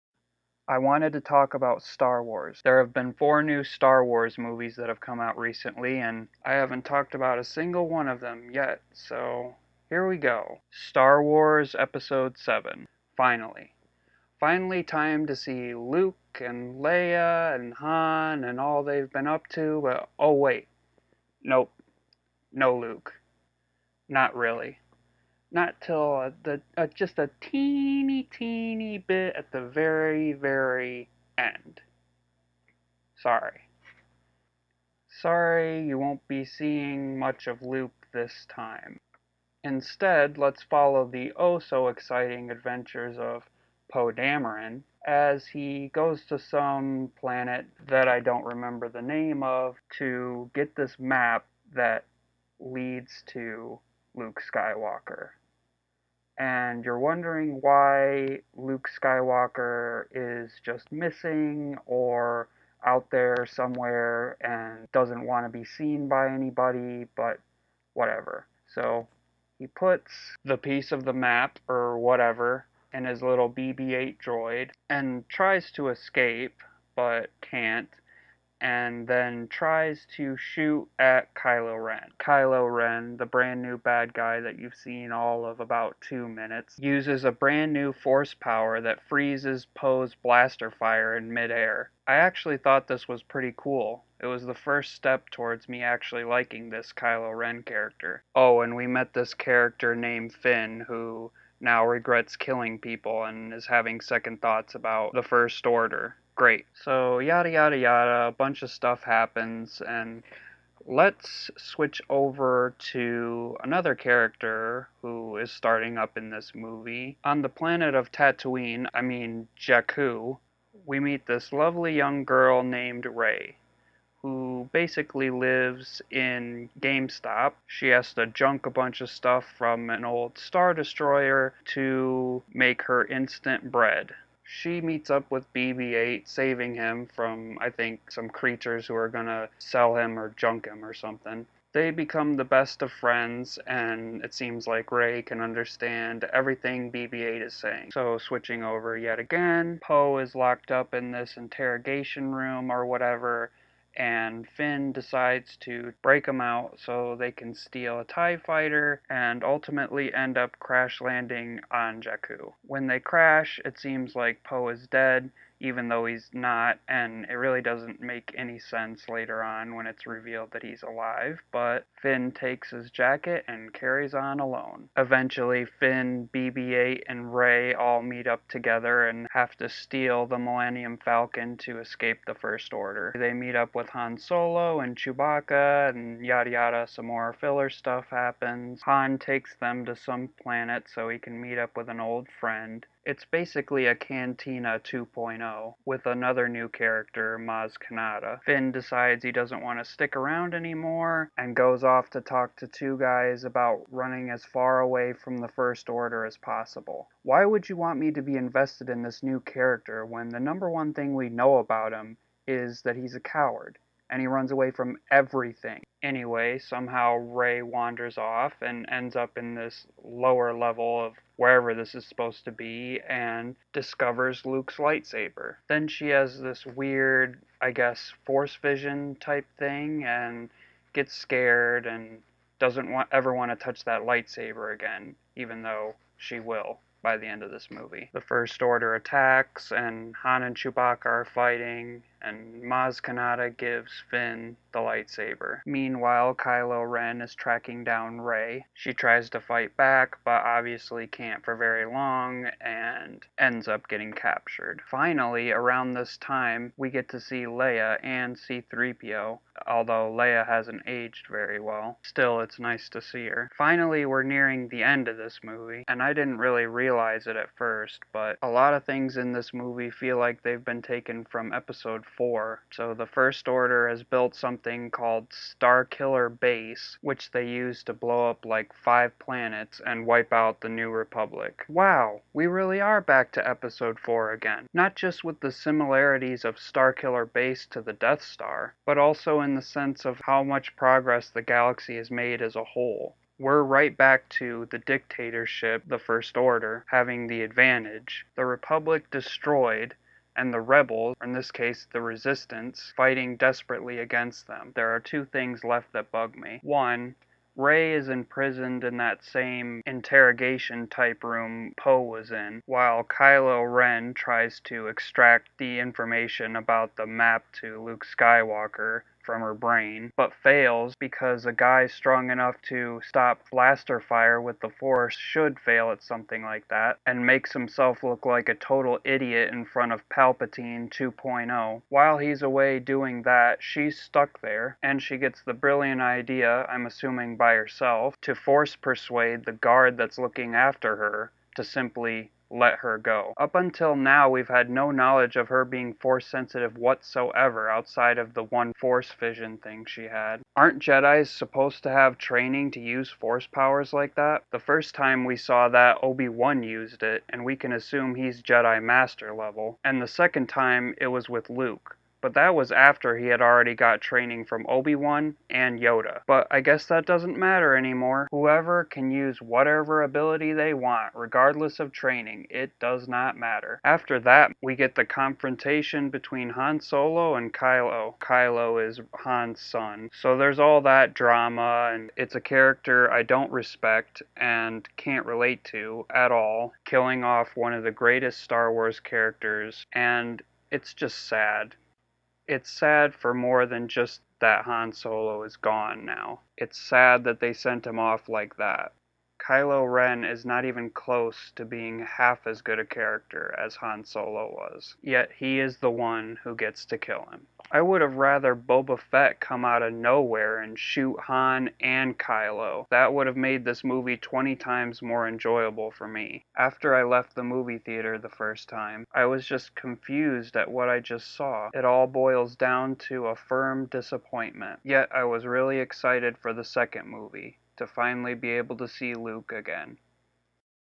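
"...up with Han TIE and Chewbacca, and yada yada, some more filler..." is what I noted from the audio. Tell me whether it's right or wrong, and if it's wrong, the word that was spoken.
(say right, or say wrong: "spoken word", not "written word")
wrong: "Solo", not "TIE".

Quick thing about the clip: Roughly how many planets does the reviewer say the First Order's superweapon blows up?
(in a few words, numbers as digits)
5.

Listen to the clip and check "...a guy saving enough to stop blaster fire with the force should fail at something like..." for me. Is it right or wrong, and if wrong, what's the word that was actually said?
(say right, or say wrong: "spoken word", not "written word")
wrong: "strong", not "saving".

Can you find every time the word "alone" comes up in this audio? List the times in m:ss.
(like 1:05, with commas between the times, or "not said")
2:54.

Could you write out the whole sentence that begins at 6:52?
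That would have made this movie 20 times more enjoyable for me.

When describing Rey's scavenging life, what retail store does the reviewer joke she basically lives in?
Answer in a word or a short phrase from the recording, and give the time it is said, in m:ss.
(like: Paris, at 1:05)
GameStop, at 2:06.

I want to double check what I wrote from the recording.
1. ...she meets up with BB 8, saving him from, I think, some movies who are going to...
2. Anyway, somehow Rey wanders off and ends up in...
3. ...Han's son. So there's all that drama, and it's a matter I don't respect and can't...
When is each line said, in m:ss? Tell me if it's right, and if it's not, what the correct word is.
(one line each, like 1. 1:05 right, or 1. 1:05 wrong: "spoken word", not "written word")
1. 2:14 wrong: "creatures", not "movies"
2. 3:36 right
3. 6:19 wrong: "character", not "matter".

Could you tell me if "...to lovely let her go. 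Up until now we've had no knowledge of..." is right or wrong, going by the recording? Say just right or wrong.
wrong.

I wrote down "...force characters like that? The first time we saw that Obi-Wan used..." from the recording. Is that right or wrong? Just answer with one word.
wrong.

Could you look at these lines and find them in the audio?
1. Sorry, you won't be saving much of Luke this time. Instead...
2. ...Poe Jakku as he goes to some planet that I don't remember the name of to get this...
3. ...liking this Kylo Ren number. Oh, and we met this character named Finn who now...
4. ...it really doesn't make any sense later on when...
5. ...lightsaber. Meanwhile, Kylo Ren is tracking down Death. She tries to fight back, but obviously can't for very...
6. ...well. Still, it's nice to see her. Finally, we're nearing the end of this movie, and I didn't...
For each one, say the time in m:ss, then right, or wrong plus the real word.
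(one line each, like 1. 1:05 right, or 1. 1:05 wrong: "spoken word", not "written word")
1. 0:35 wrong: "seeing", not "saving"
2. 0:43 wrong: "Dameron", not "Jakku"
3. 1:36 wrong: "character", not "number"
4. 2:47 right
5. 4:04 wrong: "Rey", not "Death"
6. 4:21 right.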